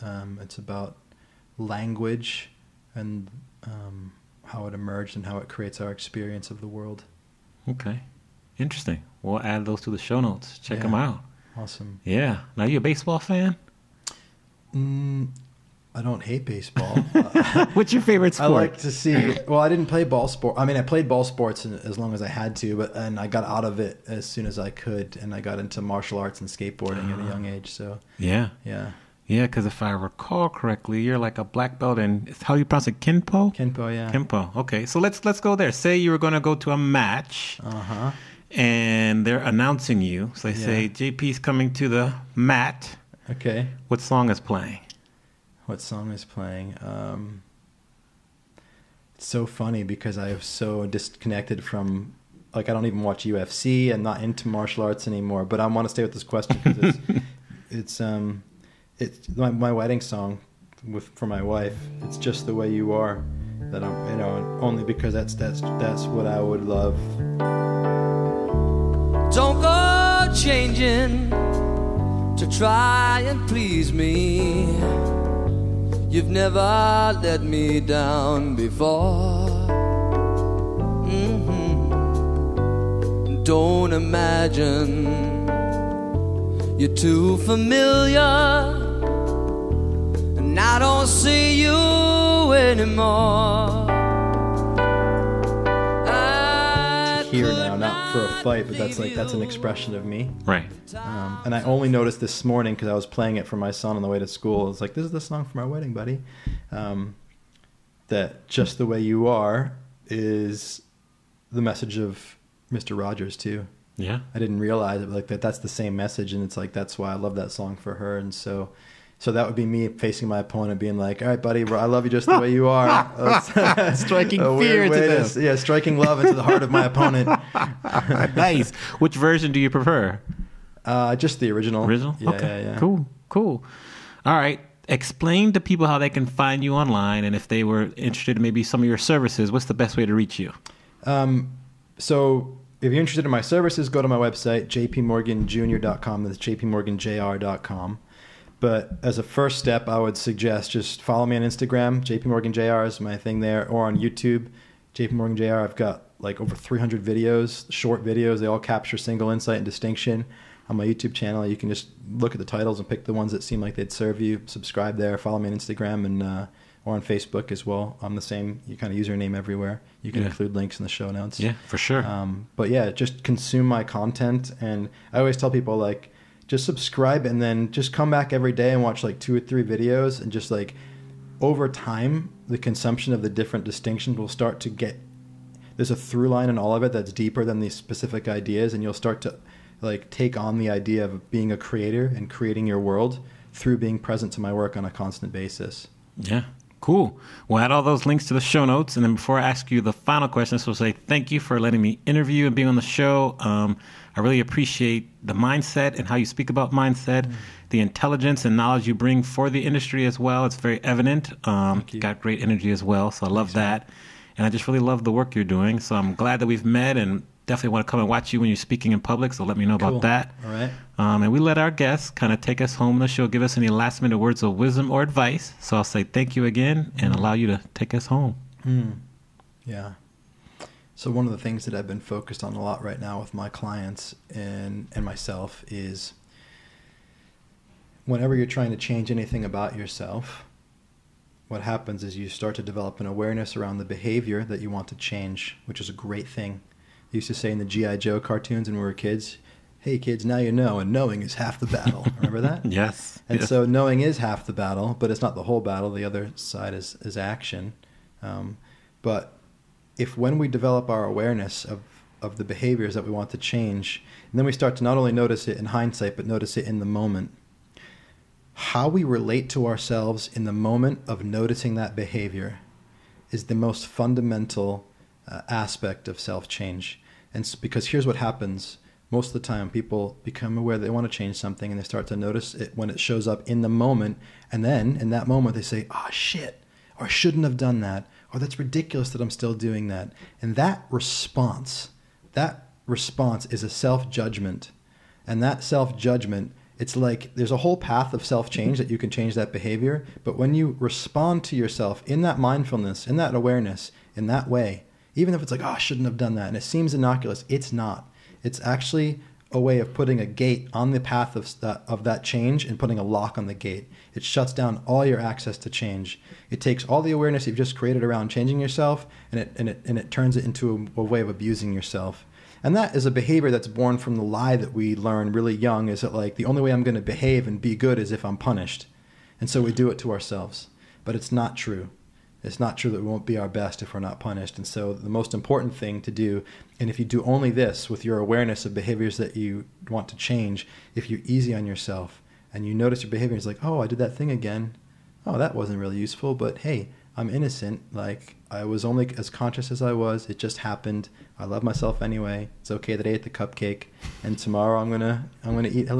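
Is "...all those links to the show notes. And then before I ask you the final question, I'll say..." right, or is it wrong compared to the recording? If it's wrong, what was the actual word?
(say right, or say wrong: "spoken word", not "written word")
right.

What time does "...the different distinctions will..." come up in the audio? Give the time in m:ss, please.
3:03.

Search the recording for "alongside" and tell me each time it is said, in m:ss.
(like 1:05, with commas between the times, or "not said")
not said.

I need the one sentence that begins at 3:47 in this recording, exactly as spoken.
allow you to take us home.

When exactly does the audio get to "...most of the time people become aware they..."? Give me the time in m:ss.
4:39.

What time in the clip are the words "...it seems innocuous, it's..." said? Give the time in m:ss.
5:06.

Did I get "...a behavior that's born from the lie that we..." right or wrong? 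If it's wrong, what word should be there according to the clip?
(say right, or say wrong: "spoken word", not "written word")
right.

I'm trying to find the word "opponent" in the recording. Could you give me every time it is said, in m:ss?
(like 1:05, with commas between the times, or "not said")
2:00, 2:06.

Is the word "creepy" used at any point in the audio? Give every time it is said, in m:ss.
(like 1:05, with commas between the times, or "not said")
not said.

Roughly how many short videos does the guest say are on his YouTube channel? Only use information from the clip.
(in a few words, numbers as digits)
over 300.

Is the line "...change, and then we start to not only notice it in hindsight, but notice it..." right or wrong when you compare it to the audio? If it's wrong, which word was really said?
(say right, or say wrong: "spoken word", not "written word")
right.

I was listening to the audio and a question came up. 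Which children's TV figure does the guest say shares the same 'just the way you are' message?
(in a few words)
Mr. Rogers.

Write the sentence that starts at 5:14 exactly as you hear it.
It shuts down all your access to change.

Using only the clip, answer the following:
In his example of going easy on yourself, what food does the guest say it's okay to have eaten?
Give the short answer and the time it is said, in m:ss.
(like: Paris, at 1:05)
cupcake, at 5:53.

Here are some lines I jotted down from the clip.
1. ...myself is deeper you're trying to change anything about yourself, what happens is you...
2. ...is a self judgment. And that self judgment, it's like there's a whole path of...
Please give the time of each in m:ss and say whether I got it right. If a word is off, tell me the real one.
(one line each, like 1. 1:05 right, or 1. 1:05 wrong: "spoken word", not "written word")
1. 3:55 wrong: "whenever", not "deeper"
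2. 4:53 right.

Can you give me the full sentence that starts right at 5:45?
Oh, that wasn't really useful, but hey, I'm innocent.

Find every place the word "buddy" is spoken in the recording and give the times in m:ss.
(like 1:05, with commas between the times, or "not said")
1:45, 2:01.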